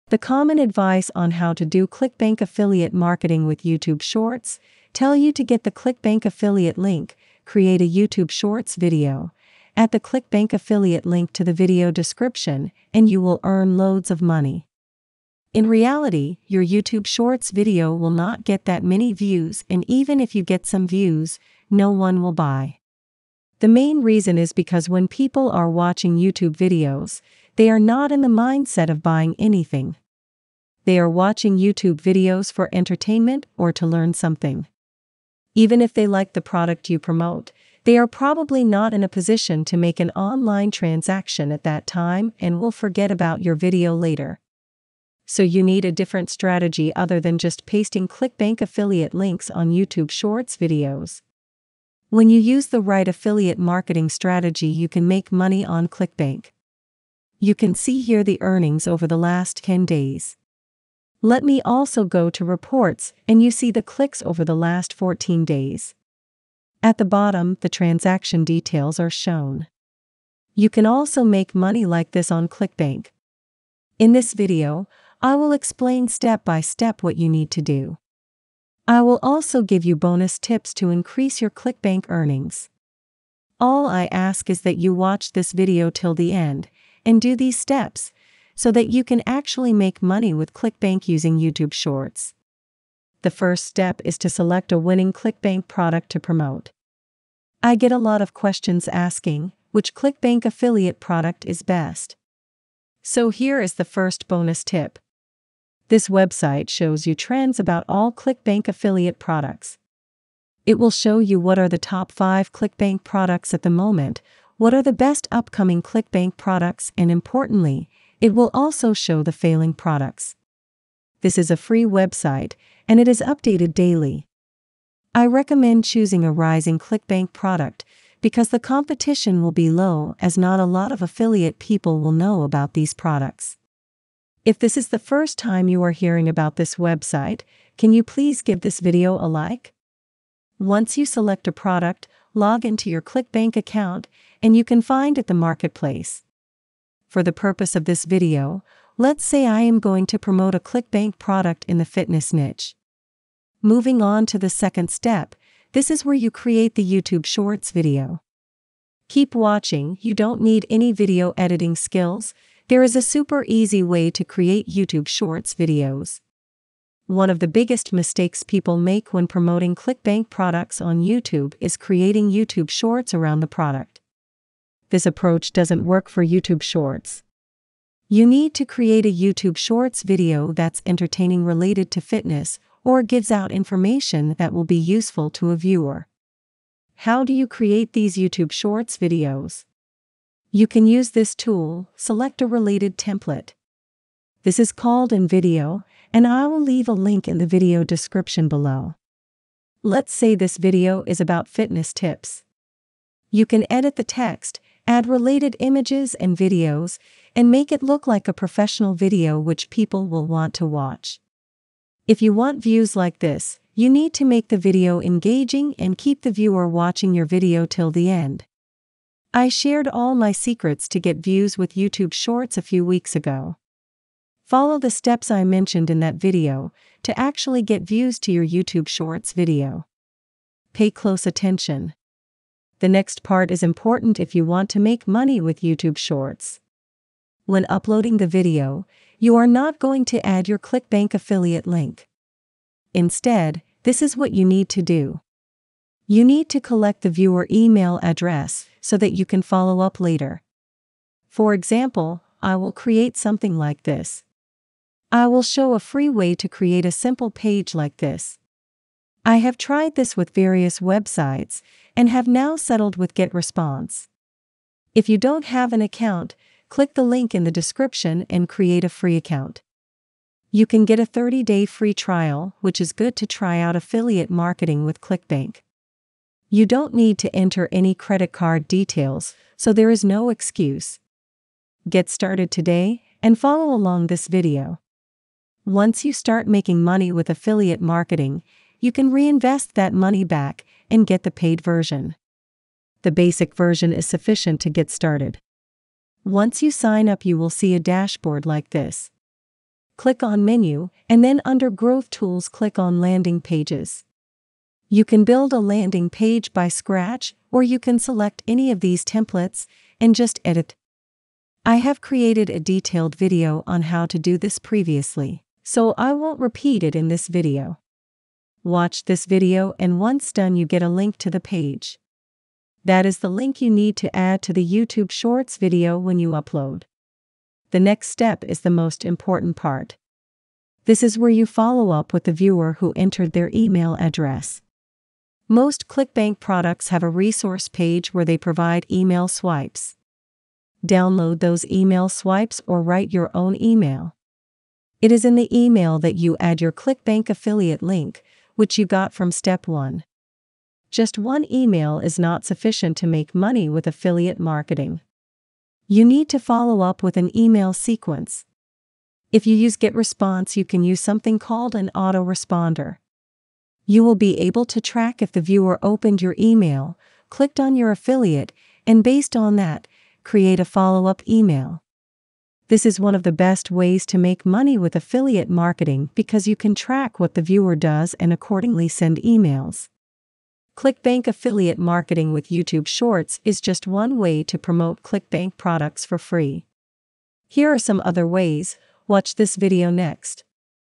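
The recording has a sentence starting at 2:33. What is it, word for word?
Moving on to the second step, this is where you create the YouTube Shorts video.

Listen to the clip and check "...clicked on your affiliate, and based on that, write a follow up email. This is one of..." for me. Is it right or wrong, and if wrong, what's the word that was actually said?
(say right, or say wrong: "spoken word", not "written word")
wrong: "create", not "write".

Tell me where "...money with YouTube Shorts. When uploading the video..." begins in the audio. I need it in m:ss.
3:55.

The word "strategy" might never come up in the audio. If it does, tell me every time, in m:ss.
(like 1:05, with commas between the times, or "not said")
0:46, 0:54.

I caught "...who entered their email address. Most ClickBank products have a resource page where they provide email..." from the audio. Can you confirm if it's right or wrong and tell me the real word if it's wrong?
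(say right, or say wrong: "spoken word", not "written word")
right.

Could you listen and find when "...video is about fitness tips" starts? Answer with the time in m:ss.
3:20.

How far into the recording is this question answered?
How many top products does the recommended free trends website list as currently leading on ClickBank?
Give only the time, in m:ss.
1:51.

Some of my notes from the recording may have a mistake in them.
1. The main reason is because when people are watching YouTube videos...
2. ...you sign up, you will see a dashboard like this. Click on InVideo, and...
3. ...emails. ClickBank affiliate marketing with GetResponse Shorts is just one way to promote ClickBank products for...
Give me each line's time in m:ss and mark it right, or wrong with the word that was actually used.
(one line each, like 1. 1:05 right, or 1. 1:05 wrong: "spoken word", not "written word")
1. 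0:23 right
2. 4:56 wrong: "Menu", not "InVideo"
3. 6:19 wrong: "YouTube", not "GetResponse".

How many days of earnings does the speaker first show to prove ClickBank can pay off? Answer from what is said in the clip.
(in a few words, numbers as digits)
10.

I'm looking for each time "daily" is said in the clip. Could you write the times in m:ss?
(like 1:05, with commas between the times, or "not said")
2:03.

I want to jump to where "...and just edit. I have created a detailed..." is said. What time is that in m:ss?
5:09.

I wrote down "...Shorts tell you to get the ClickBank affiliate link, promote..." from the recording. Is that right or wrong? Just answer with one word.
wrong.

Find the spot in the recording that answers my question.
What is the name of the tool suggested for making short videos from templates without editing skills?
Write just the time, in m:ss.
3:15.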